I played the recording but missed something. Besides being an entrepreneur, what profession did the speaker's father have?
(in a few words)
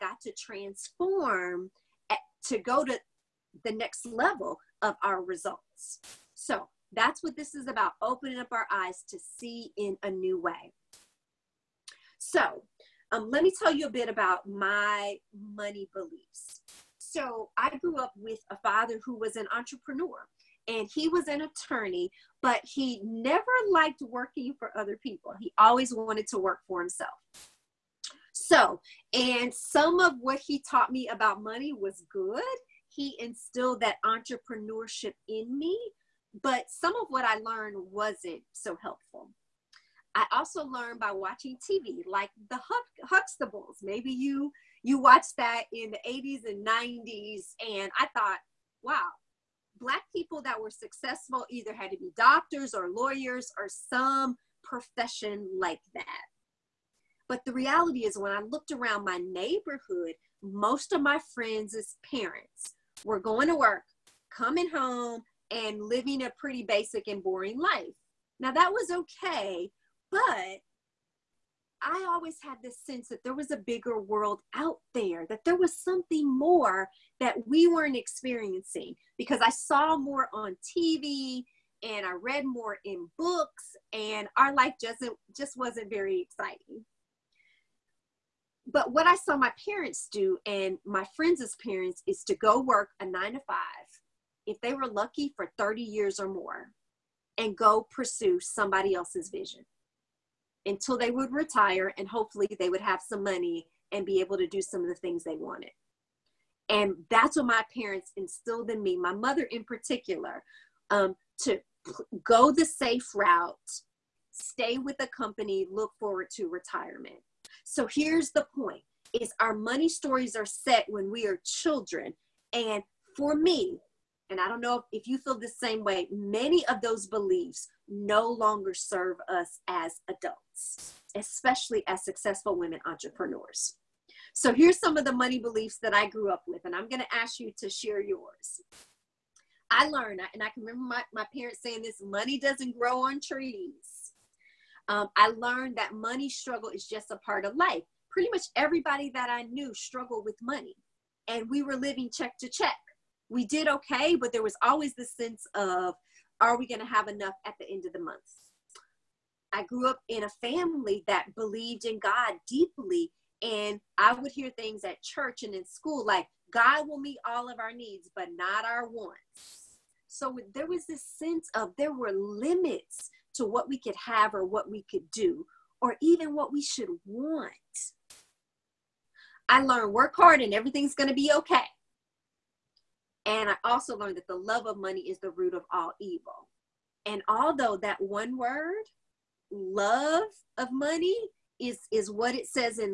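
attorney.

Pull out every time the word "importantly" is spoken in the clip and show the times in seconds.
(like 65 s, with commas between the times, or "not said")
not said.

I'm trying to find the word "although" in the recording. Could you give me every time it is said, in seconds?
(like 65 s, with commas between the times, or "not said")
187 s.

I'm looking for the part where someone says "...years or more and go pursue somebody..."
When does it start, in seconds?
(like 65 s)
95 s.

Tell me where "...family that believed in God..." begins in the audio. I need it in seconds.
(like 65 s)
160 s.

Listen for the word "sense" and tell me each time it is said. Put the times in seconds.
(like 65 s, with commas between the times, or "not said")
72 s, 155 s, 171 s.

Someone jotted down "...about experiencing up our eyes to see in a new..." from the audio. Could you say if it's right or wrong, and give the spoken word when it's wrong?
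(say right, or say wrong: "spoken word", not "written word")
wrong: "opening", not "experiencing".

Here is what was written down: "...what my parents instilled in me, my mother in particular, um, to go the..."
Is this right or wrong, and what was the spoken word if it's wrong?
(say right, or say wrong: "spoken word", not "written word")
right.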